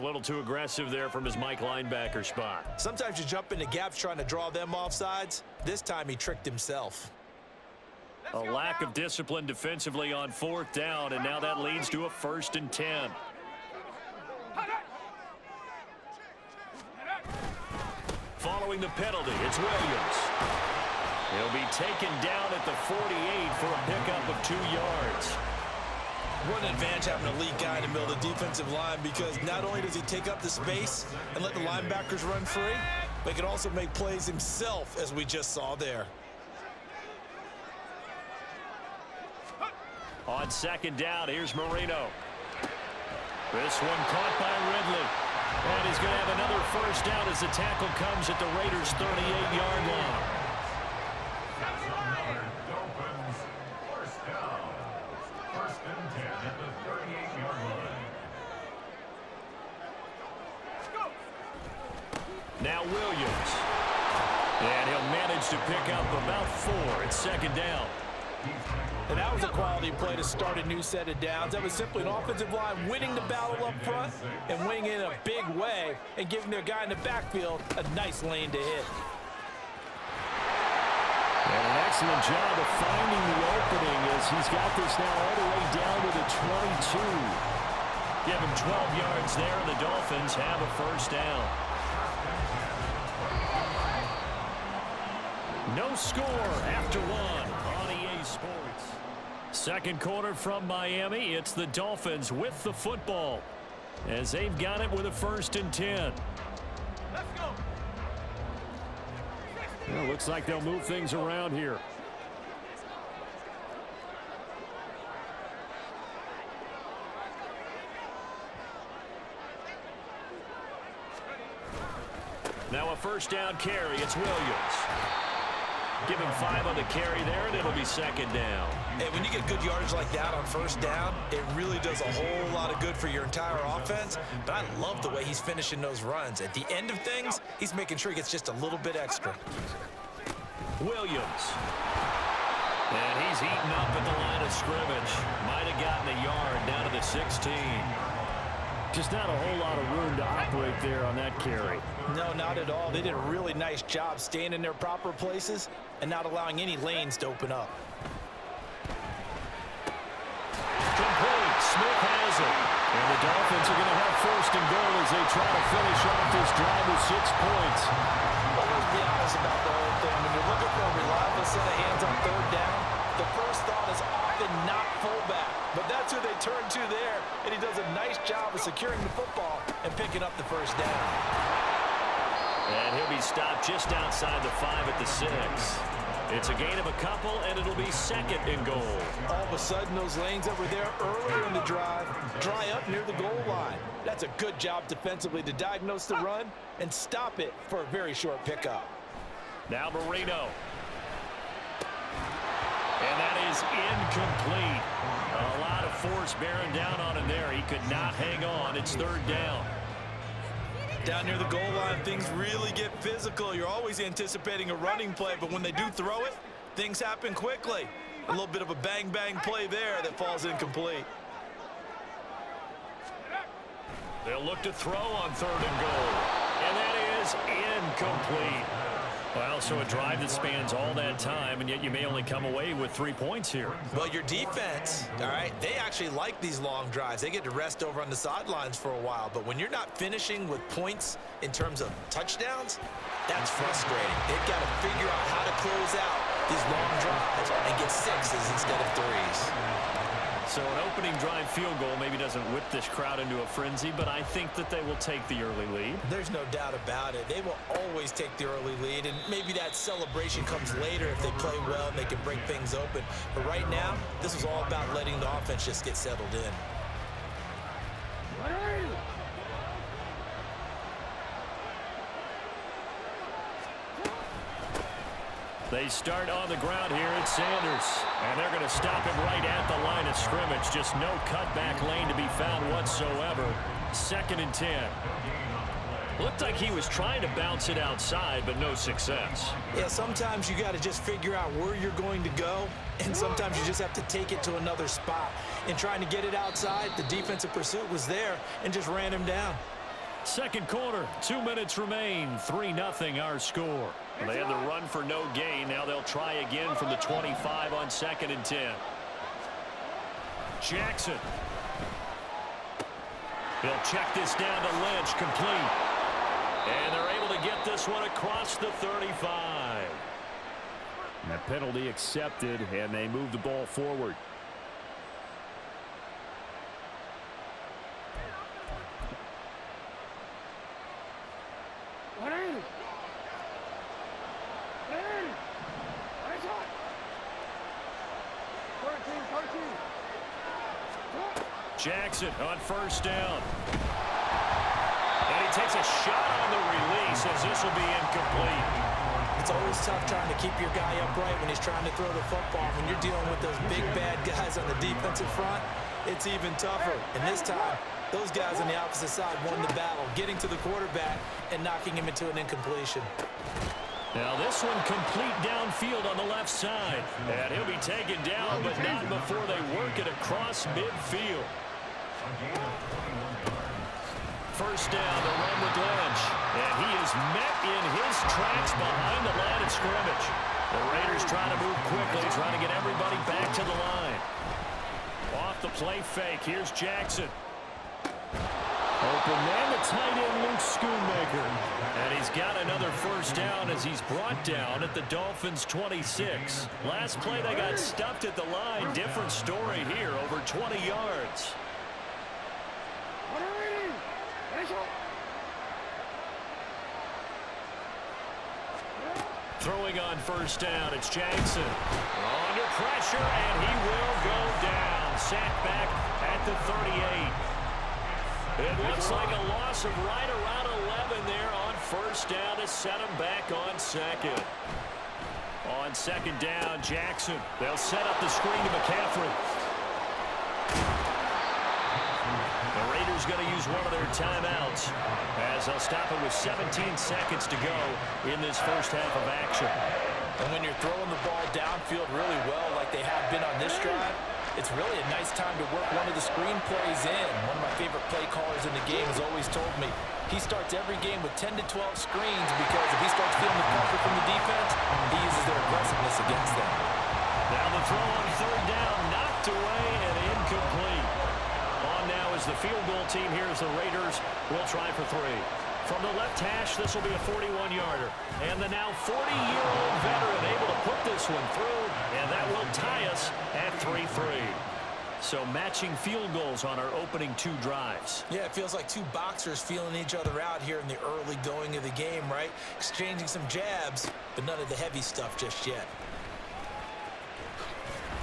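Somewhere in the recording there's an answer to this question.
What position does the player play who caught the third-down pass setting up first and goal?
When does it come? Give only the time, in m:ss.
2:55.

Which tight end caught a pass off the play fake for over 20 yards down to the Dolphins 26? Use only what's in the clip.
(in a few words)
Luke Schoonmaker.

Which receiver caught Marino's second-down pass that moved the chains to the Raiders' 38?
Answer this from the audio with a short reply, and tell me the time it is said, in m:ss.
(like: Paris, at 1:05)
Ridley, at 0:44.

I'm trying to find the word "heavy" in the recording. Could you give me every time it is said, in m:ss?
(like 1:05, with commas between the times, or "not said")
8:04.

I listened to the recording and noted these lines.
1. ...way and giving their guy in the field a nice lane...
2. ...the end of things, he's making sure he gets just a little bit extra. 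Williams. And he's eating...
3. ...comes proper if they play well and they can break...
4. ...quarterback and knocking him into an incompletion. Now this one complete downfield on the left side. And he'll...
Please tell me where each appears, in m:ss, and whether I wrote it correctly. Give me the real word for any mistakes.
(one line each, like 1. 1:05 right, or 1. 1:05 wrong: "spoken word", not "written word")
1. 1:15 wrong: "backfield", not "field"
2. 2:16 right
3. 4:20 wrong: "later", not "proper"
4. 6:00 right.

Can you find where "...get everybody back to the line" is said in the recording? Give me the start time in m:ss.
6:22.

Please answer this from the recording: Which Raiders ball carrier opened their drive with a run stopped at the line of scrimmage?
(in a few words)
Sanders.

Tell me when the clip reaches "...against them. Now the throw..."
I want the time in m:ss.
7:36.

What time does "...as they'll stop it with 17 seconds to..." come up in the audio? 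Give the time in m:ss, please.
7:15.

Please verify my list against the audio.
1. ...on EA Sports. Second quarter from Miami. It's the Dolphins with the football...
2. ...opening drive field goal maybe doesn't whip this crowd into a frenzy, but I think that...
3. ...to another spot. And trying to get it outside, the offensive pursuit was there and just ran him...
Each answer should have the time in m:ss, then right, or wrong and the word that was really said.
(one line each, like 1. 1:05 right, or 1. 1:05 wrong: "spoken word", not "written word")
1. 1:37 right
2. 4:10 right
3. 4:54 wrong: "defensive", not "offensive".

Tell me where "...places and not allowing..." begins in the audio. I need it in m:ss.
2:35.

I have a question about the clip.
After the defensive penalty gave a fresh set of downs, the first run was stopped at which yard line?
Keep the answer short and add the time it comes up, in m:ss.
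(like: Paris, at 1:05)
48, at 0:22.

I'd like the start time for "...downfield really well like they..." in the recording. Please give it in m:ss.
7:21.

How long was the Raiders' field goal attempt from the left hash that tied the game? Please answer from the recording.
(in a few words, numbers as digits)
41 yards.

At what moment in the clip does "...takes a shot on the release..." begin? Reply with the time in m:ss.
5:45.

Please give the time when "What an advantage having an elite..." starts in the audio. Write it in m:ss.
0:26.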